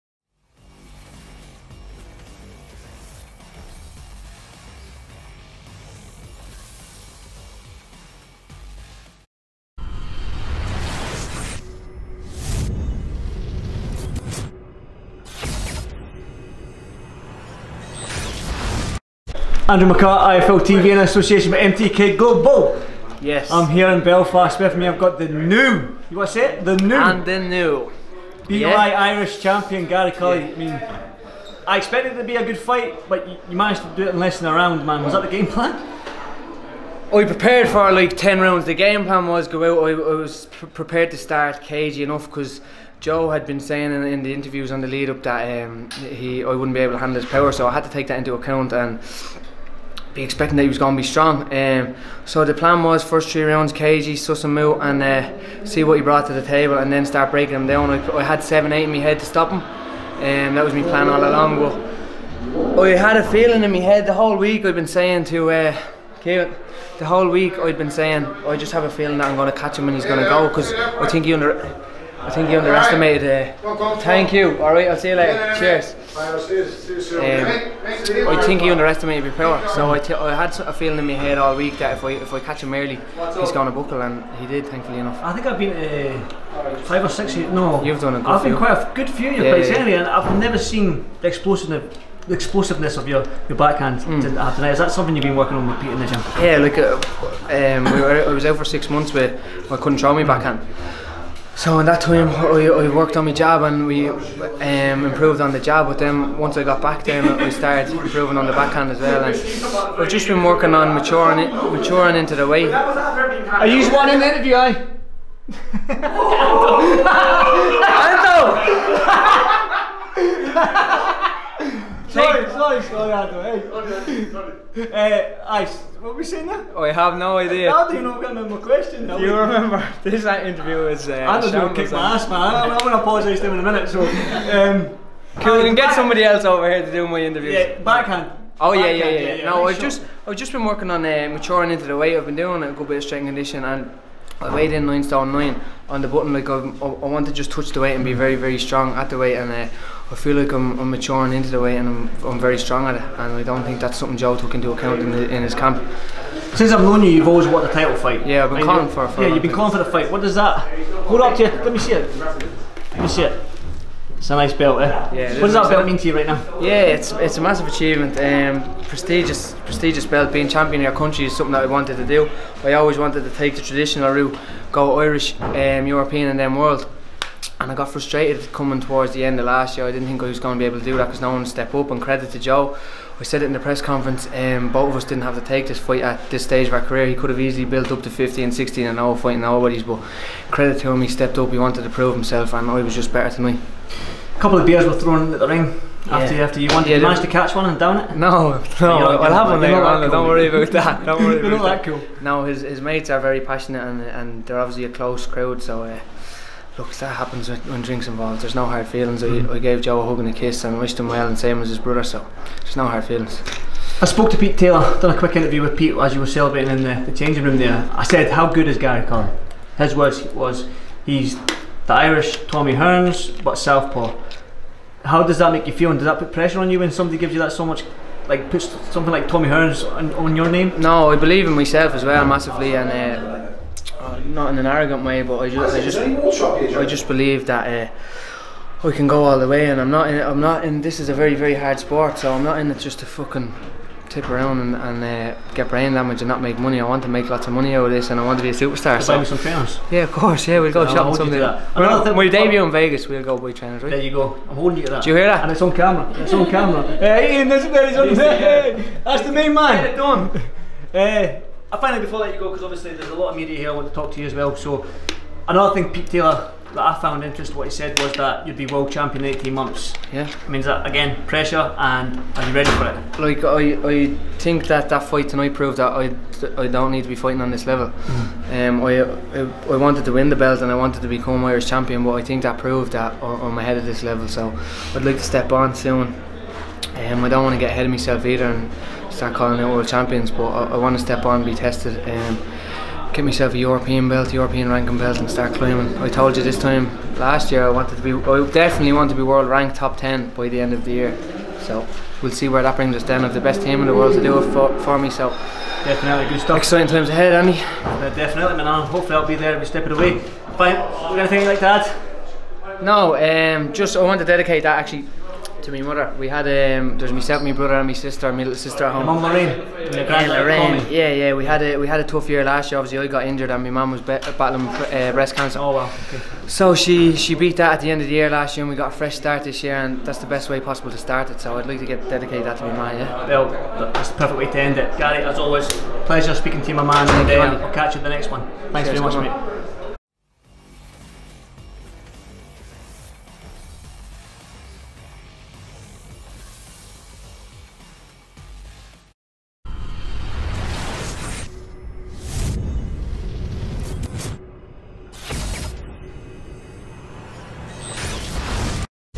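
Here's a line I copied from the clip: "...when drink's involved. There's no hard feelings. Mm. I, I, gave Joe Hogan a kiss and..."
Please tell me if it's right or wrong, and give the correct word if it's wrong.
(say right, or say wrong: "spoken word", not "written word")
right.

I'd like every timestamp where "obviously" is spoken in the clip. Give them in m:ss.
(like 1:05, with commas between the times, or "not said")
3:24, 4:22, 5:22.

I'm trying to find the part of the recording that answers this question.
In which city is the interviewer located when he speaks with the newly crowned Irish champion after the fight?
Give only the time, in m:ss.
0:24.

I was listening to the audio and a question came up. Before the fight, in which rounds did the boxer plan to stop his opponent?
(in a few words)
7 or 8.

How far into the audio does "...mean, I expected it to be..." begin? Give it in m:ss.
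0:30.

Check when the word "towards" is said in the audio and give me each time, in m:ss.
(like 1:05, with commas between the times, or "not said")
2:58.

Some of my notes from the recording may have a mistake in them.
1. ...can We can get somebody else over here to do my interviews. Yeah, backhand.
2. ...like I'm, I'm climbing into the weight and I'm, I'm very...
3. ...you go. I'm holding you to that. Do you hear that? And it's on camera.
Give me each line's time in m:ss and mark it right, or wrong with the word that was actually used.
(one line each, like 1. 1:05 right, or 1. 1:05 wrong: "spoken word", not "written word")
1. 2:15 right
2. 2:30 wrong: "maturing", not "climbing"
3. 4:14 right.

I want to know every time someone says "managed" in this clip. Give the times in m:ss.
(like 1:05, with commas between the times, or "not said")
0:33, 3:17.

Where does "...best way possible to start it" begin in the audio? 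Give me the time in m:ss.
5:30.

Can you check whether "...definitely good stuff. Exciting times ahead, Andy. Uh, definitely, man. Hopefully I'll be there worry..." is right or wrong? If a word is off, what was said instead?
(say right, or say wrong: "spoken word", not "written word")
wrong: "every", not "worry".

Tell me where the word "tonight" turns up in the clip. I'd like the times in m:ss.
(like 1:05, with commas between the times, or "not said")
1:34, 4:35.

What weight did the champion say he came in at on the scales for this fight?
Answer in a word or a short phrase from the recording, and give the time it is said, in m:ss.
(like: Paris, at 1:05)
9 stone 9, at 2:24.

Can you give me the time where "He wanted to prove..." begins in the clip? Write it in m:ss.
3:11.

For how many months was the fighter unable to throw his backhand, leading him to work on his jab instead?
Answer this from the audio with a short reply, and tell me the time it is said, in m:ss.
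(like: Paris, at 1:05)
6, at 1:38.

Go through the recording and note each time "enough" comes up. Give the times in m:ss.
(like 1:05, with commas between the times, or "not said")
0:42, 1:24.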